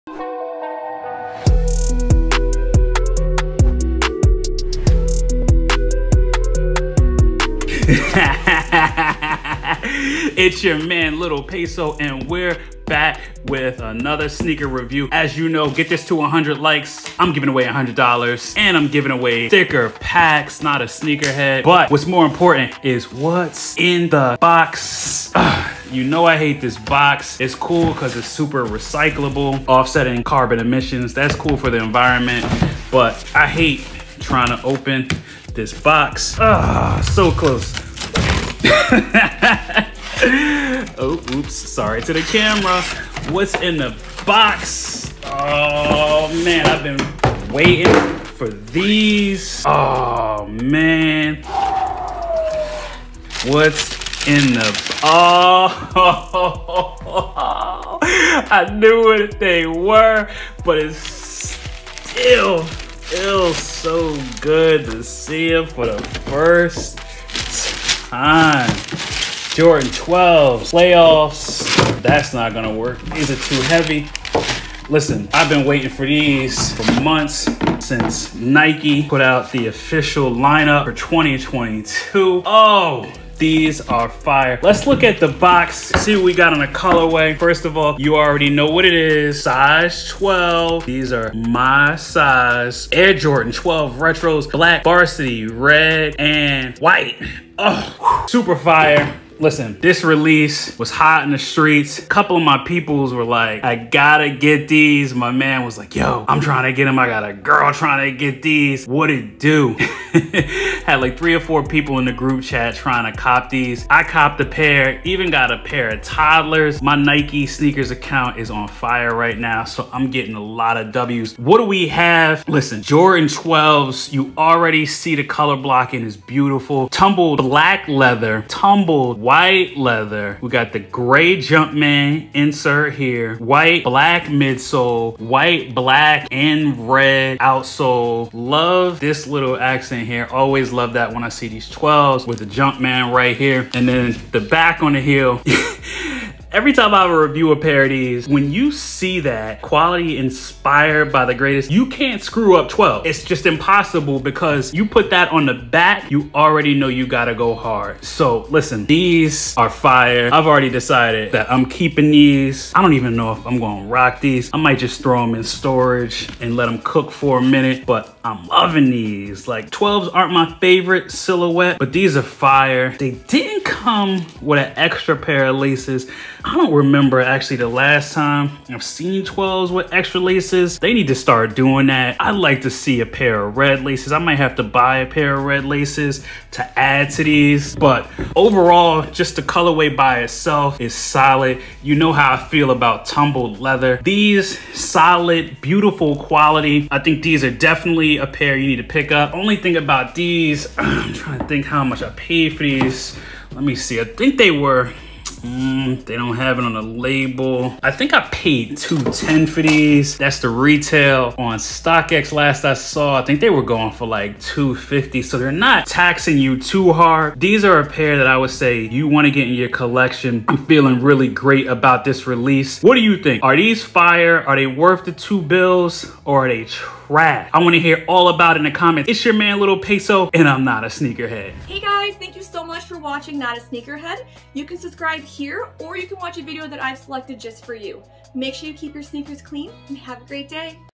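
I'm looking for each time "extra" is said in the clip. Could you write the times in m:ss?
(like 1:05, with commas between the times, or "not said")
2:54, 2:59.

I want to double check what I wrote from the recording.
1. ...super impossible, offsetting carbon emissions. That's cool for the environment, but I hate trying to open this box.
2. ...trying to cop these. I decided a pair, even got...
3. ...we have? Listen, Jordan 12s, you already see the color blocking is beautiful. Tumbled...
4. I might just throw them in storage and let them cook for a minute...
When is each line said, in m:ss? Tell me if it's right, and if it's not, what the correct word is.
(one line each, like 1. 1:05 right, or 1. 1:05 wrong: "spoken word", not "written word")
1. 0:28 wrong: "recyclable", not "impossible"
2. 1:52 wrong: "copped", not "decided"
3. 2:01 right
4. 2:44 right.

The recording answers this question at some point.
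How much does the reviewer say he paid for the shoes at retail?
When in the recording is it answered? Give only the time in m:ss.
3:28.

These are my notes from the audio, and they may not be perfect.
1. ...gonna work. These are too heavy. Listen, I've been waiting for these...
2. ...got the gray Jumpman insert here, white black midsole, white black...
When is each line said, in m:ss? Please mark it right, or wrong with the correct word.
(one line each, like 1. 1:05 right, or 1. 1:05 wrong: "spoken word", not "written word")
1. 1:12 right
2. 2:10 right.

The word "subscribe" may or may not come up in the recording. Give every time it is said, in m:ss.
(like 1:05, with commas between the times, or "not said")
3:54.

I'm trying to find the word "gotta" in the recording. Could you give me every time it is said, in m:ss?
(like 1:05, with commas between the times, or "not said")
1:43, 2:37.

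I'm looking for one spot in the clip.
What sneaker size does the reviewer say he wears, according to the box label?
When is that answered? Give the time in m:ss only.
1:29.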